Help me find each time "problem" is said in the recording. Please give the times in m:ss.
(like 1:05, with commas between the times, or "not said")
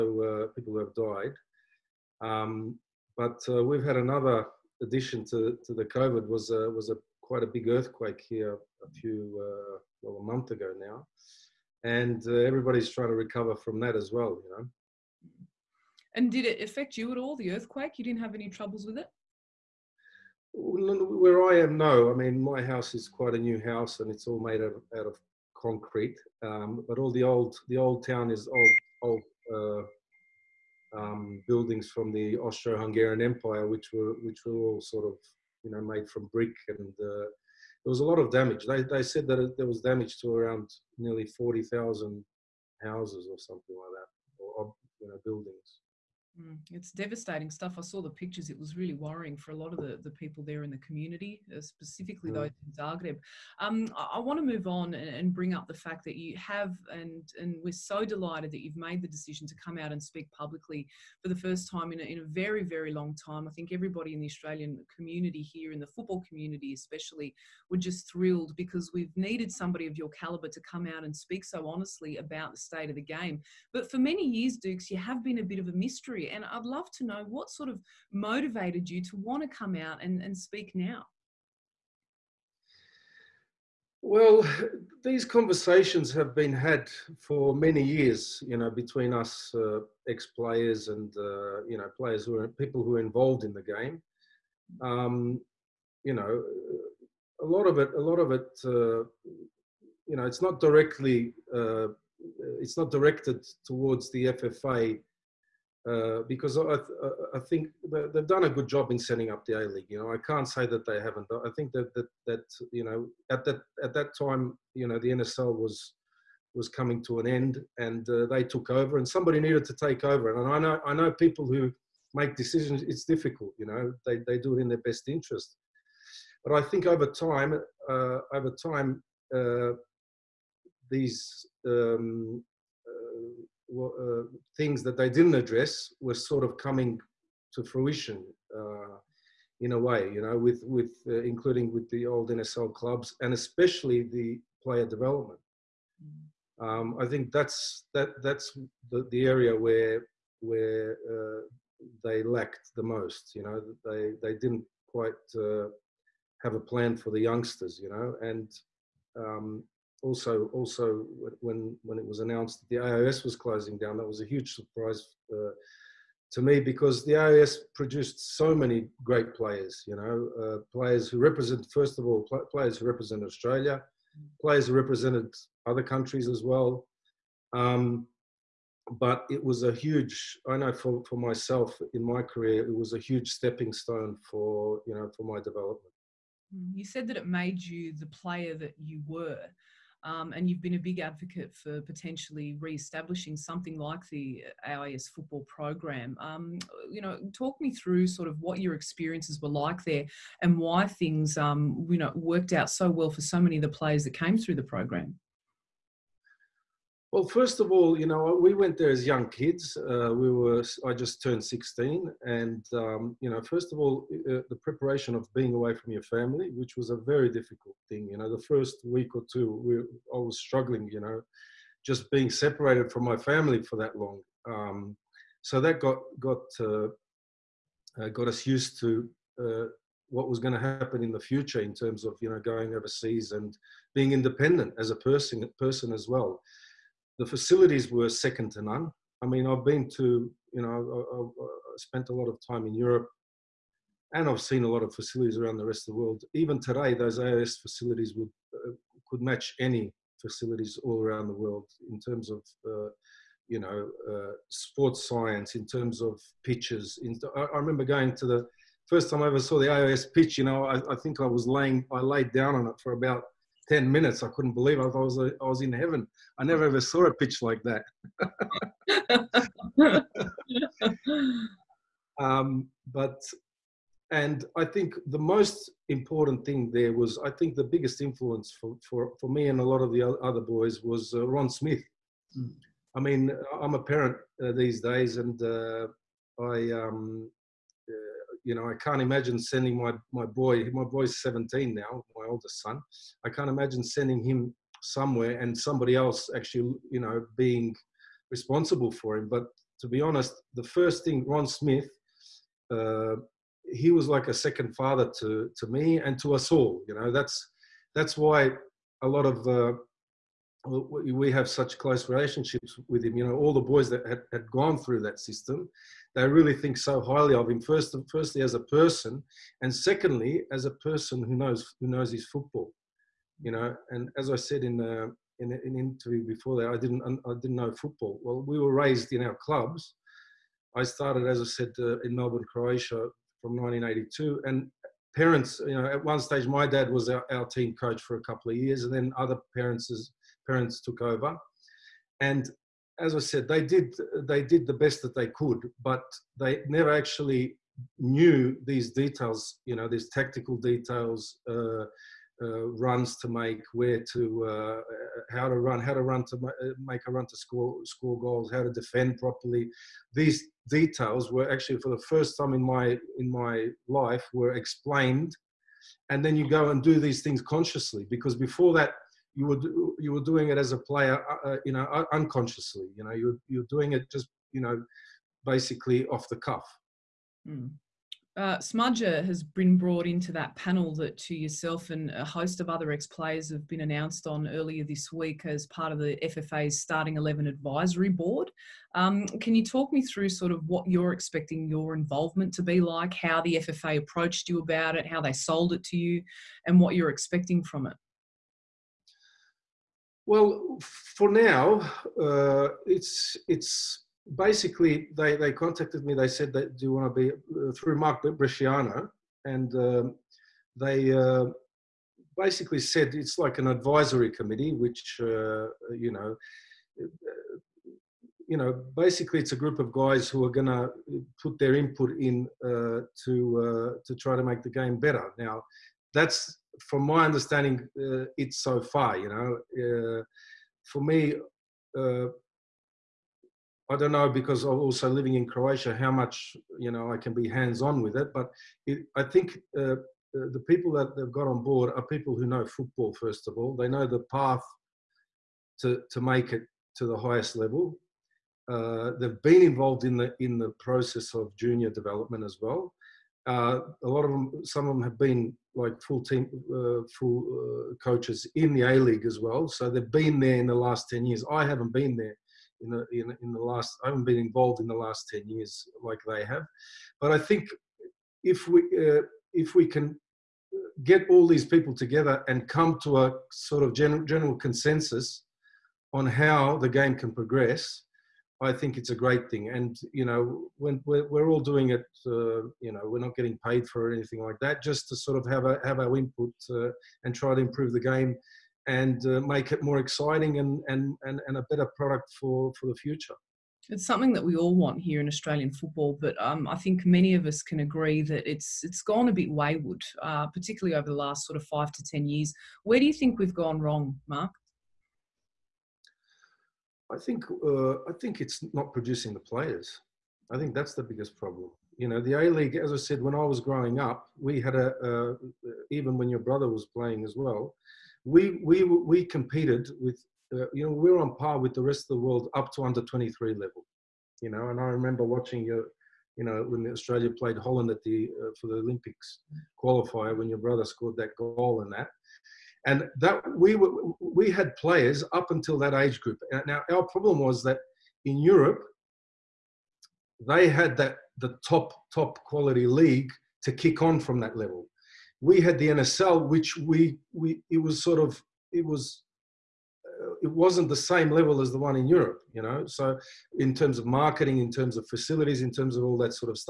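8:31, 8:57.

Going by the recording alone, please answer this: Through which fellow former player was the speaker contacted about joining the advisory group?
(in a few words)
Mark Bresciano.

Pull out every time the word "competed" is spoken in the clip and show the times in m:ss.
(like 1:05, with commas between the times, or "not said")
8:39.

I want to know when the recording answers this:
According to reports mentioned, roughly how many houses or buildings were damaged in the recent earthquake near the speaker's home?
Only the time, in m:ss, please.
0:41.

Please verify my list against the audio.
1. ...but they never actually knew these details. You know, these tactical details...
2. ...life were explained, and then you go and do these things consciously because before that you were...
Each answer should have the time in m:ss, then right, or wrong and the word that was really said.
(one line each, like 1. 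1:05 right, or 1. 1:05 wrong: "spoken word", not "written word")
1. 5:45 right
2. 6:03 right.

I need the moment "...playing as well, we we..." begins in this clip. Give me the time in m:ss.
8:36.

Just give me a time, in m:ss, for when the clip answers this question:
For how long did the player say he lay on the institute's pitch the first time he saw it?
4:23.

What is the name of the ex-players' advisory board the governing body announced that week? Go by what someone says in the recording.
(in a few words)
Starting 11.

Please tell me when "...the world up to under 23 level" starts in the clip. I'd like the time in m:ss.
8:42.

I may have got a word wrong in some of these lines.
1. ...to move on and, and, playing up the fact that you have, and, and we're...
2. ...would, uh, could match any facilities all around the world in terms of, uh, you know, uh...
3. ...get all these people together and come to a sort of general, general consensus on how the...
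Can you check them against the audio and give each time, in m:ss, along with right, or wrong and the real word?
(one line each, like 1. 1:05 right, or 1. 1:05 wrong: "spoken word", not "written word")
1. 0:54 wrong: "bring", not "playing"
2. 4:08 right
3. 7:51 right.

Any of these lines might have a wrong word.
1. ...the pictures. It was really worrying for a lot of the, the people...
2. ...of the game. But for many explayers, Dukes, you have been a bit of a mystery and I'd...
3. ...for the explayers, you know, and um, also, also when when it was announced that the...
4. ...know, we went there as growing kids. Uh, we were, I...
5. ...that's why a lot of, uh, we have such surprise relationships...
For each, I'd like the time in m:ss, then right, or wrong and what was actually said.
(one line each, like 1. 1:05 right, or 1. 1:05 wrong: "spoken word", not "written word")
1. 0:48 right
2. 1:12 wrong: "years", not "explayers"
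3. 2:36 wrong: "youngsters", not "explayers"
4. 3:28 wrong: "young", not "growing"
5. 5:07 wrong: "close", not "surprise".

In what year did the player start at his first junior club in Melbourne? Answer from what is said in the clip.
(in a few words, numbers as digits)
1982.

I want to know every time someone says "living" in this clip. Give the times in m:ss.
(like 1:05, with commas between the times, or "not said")
7:15.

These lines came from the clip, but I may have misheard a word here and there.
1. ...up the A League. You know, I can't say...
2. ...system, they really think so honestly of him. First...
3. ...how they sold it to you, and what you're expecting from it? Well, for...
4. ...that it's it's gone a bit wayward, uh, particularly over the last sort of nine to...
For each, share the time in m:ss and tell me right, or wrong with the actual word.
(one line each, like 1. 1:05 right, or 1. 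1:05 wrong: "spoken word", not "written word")
1. 1:49 right
2. 5:15 wrong: "highly", not "honestly"
3. 6:35 right
4. 8:18 wrong: "five", not "nine".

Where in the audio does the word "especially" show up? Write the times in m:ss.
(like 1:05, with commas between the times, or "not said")
1:06, 2:23.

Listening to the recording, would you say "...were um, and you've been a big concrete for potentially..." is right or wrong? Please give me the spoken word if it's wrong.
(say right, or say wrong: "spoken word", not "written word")
wrong: "advocate", not "concrete".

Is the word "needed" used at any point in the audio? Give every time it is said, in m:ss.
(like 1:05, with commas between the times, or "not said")
1:09, 1:59.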